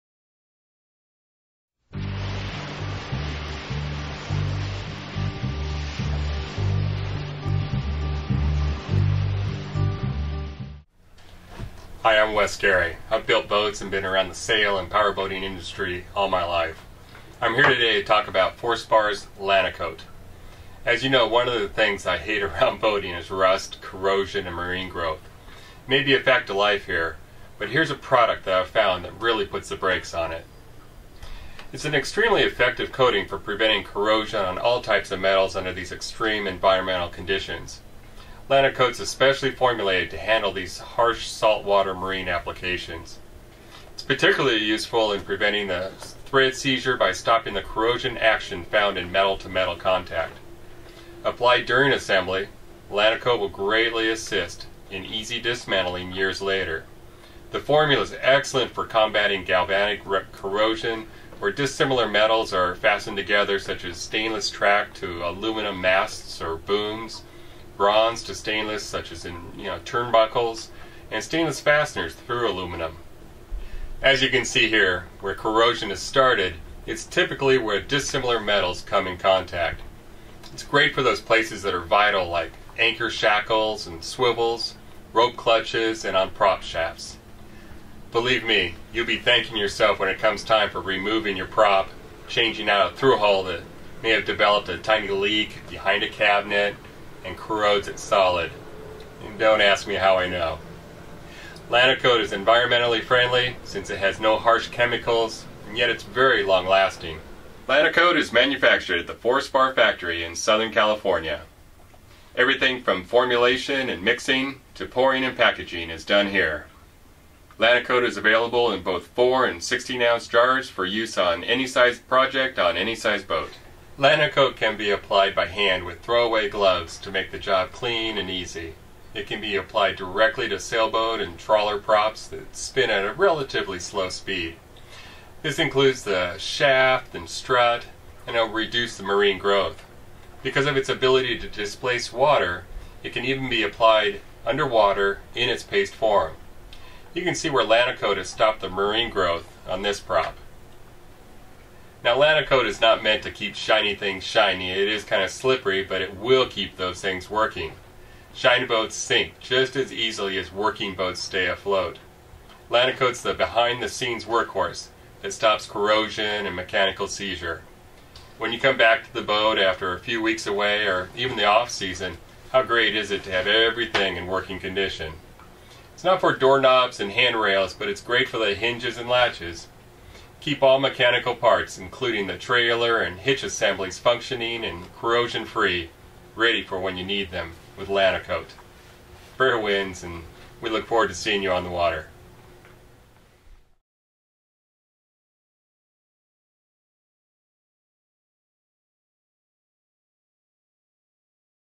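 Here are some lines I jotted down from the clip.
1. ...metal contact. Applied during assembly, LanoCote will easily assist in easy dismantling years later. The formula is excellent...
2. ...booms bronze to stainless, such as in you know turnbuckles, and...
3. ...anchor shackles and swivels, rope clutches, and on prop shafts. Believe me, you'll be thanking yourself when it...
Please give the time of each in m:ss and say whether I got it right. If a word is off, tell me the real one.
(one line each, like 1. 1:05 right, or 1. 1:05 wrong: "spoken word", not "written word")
1. 0:49 wrong: "greatly", not "easily"
2. 1:06 right
3. 1:22 right.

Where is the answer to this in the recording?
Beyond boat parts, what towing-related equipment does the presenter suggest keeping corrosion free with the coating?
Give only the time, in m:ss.
3:02.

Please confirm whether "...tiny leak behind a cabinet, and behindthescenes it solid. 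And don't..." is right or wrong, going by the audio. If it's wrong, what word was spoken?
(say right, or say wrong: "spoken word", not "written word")
wrong: "corrodes", not "behindthescenes".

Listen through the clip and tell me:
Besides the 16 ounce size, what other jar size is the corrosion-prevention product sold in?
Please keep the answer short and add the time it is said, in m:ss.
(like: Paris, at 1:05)
4 ounce, at 1:59.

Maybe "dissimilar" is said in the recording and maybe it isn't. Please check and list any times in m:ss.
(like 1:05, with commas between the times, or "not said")
1:01, 1:17.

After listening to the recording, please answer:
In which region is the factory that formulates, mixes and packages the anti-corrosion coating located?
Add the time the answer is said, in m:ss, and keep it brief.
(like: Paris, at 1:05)
Southern California, at 1:50.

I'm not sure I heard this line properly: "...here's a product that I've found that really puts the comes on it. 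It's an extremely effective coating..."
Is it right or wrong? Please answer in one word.
wrong.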